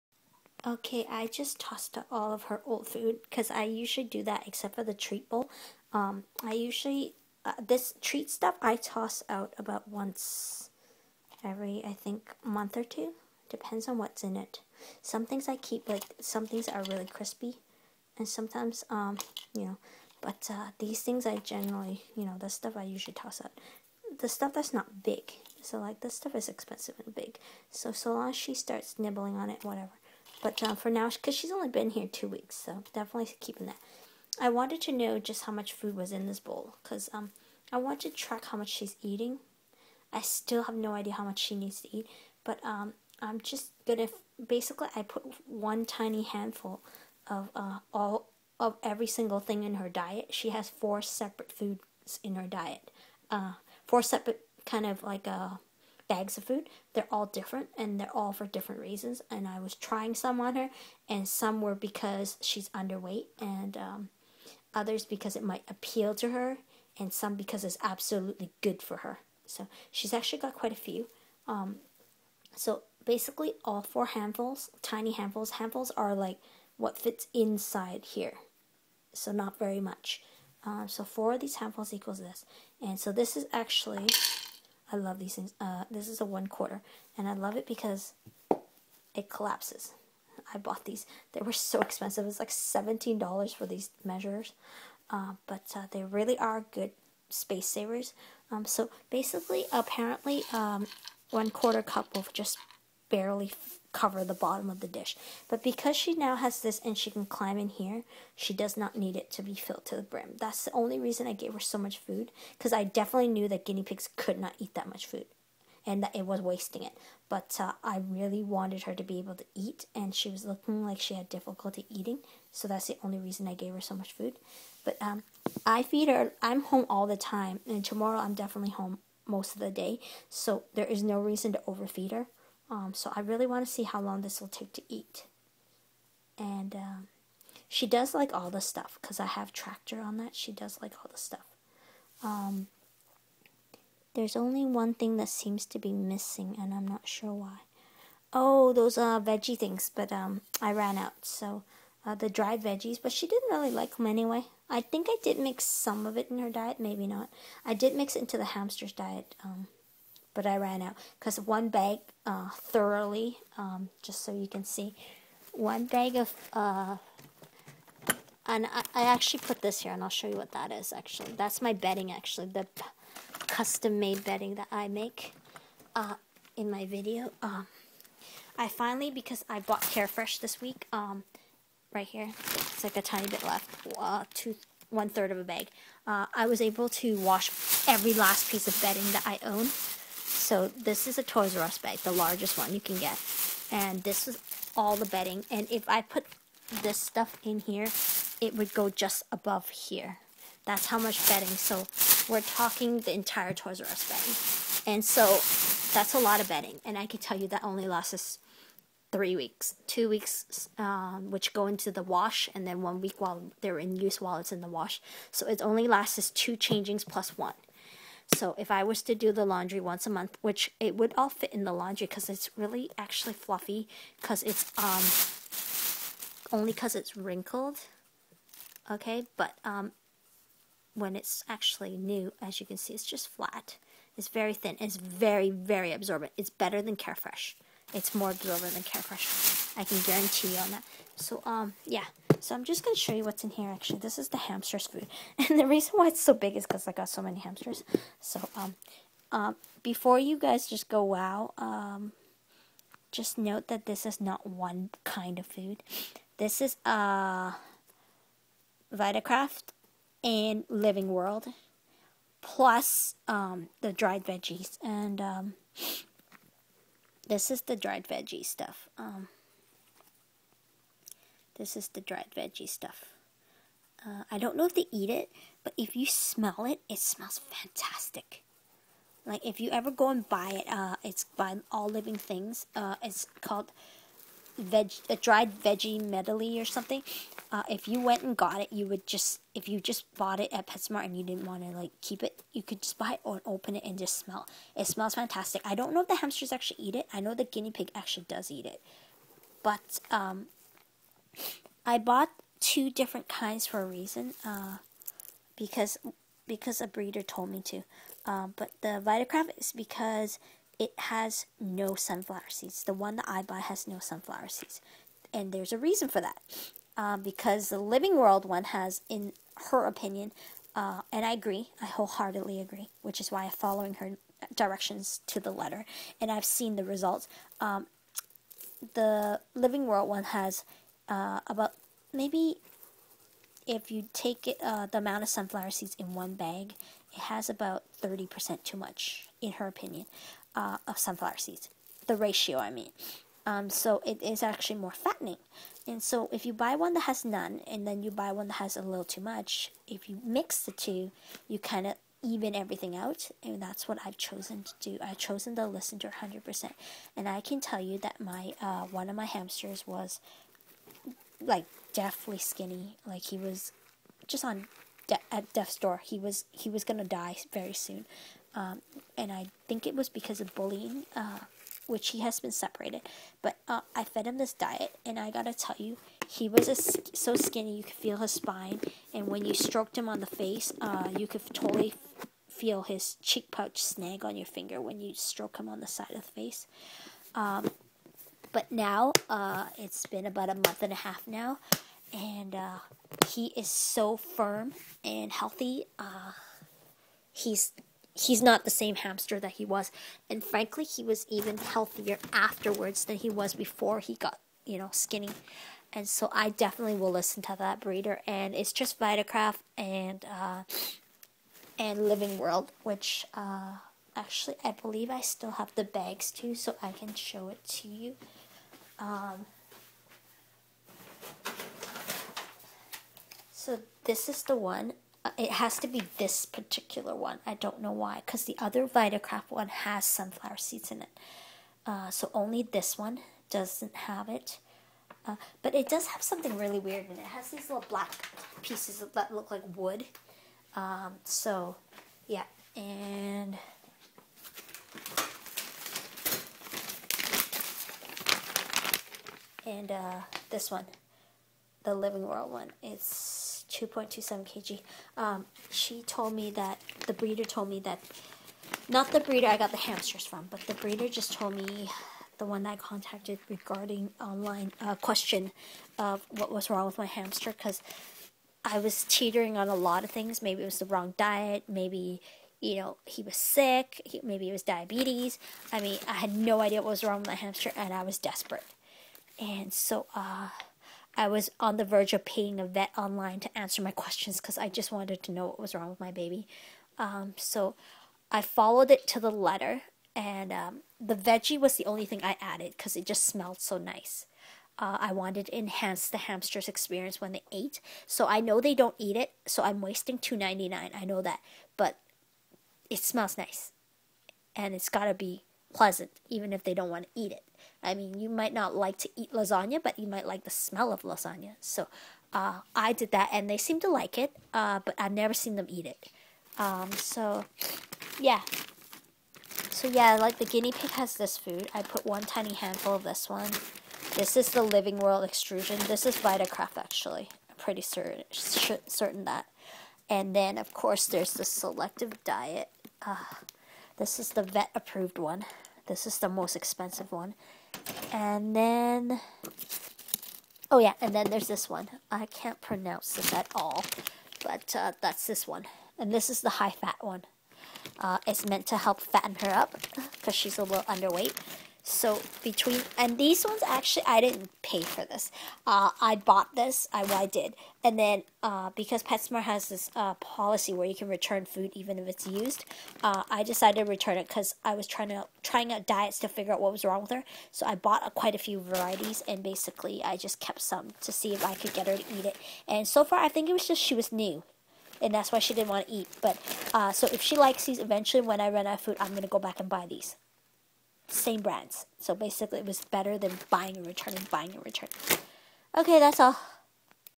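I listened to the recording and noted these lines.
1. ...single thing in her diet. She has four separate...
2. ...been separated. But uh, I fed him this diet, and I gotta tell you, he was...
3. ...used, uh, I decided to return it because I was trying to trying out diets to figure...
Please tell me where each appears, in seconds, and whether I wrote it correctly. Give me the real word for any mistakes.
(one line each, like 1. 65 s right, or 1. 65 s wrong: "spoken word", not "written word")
1. 49 s right
2. 372 s right
3. 562 s right.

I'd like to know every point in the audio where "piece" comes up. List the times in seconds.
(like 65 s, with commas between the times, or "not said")
188 s, 438 s.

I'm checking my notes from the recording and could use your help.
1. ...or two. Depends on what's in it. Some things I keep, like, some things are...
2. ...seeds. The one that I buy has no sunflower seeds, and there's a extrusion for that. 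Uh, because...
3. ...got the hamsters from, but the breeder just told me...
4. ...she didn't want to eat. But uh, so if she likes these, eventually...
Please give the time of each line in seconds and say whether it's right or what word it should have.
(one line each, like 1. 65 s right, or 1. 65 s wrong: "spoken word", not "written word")
1. 12 s right
2. 312 s wrong: "reason", not "extrusion"
3. 459 s right
4. 575 s right.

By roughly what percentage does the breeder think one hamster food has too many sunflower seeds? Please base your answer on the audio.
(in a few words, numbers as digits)
30%.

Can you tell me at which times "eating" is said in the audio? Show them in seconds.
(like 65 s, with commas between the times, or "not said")
39 s, 121 s.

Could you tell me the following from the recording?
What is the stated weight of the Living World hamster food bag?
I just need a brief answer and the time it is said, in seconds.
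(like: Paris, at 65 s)
2.27 kg, at 453 s.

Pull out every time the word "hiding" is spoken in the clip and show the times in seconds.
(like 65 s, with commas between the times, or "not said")
not said.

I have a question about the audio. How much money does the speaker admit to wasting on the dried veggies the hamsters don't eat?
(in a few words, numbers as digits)
$2.99.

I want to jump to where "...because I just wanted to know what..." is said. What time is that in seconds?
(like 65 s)
484 s.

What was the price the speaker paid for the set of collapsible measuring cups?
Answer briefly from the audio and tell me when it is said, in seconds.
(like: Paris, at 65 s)
$17, at 92 s.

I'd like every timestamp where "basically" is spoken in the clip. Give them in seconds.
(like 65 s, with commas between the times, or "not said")
44 s, 73 s, 99 s, 569 s, 582 s.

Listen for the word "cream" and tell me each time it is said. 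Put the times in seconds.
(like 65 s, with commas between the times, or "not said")
not said.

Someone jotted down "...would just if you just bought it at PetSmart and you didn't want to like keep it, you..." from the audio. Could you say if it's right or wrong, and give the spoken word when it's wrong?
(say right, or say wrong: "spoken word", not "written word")
right.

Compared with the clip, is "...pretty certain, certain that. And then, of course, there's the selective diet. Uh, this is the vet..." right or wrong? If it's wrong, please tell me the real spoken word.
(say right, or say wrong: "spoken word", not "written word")
right.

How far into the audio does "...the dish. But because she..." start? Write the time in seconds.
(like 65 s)
104 s.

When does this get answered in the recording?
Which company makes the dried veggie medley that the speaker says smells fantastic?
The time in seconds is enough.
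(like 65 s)
281 s.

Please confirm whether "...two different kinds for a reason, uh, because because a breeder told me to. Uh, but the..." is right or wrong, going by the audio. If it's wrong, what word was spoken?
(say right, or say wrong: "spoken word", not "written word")
right.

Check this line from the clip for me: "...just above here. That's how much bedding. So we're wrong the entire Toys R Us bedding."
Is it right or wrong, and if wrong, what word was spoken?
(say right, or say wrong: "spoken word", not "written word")
wrong: "talking", not "wrong".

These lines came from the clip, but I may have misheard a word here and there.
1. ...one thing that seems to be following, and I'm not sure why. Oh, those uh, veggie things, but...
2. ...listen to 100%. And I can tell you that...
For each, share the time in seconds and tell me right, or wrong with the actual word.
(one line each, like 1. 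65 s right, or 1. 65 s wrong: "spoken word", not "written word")
1. 144 s wrong: "missing", not "following"
2. 355 s right.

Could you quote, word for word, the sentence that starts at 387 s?
Um, but now, uh, it's been about a month and a half now, and uh, he is so firm and healthy.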